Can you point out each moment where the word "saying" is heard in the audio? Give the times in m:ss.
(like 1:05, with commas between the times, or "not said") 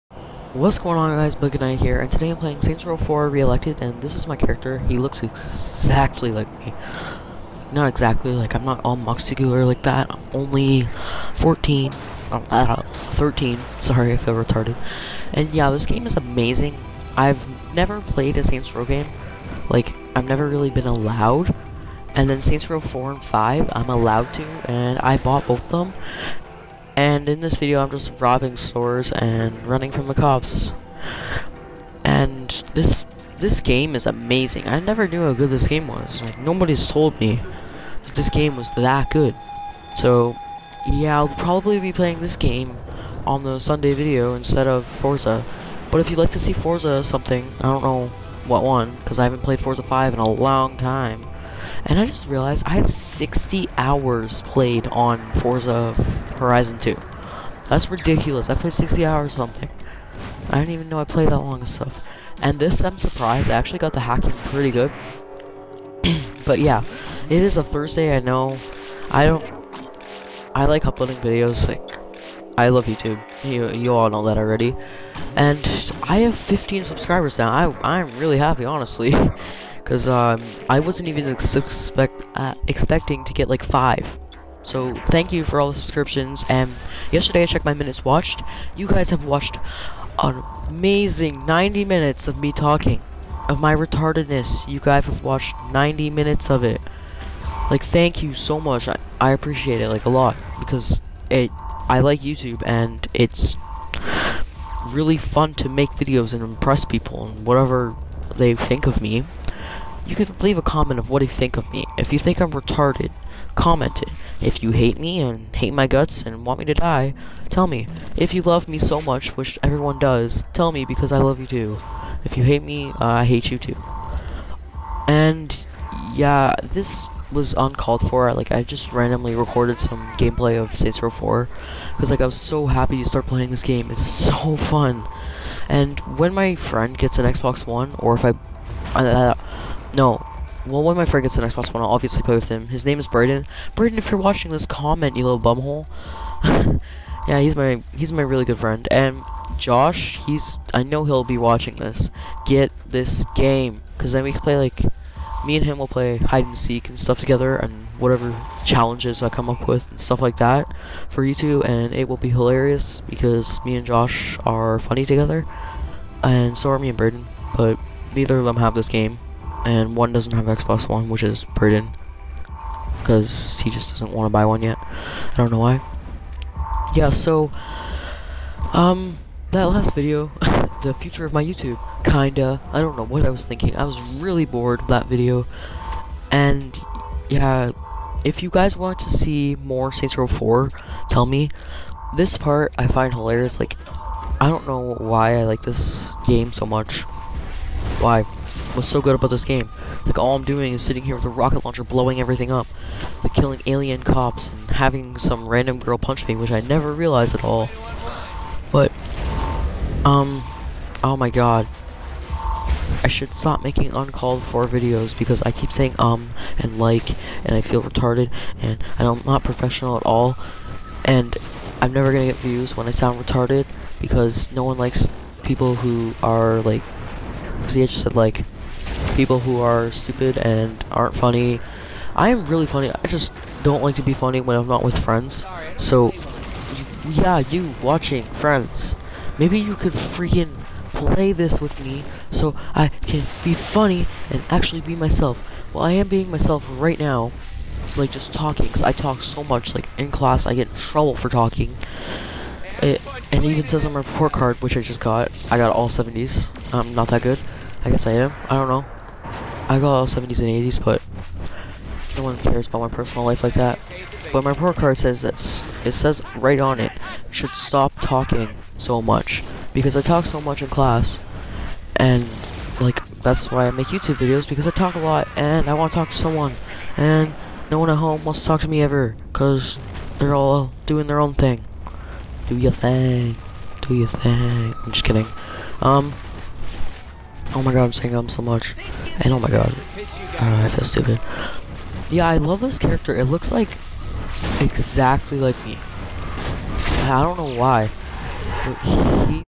3:35, 4:47.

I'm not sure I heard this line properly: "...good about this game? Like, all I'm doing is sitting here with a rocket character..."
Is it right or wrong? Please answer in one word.
wrong.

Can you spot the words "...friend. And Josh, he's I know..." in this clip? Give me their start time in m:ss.
2:28.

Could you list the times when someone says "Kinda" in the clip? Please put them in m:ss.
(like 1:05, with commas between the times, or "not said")
3:02.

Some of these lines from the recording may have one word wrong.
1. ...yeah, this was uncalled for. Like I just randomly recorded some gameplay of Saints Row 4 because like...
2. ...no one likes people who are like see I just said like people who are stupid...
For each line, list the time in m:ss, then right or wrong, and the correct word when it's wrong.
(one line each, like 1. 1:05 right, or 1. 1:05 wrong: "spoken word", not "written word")
1. 2:06 right
2. 3:44 right.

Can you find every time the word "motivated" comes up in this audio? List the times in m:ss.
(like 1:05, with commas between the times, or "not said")
not said.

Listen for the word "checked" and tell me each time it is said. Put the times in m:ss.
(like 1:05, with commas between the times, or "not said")
1:27.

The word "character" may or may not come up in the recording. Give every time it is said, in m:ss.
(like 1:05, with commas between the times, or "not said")
0:04, 4:52.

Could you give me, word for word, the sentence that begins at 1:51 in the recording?
If you think I'm retarded, comment it.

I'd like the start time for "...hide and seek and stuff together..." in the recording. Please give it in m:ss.
2:36.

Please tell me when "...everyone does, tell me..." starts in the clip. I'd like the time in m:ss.
1:59.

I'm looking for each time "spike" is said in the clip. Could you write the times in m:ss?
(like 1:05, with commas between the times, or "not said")
not said.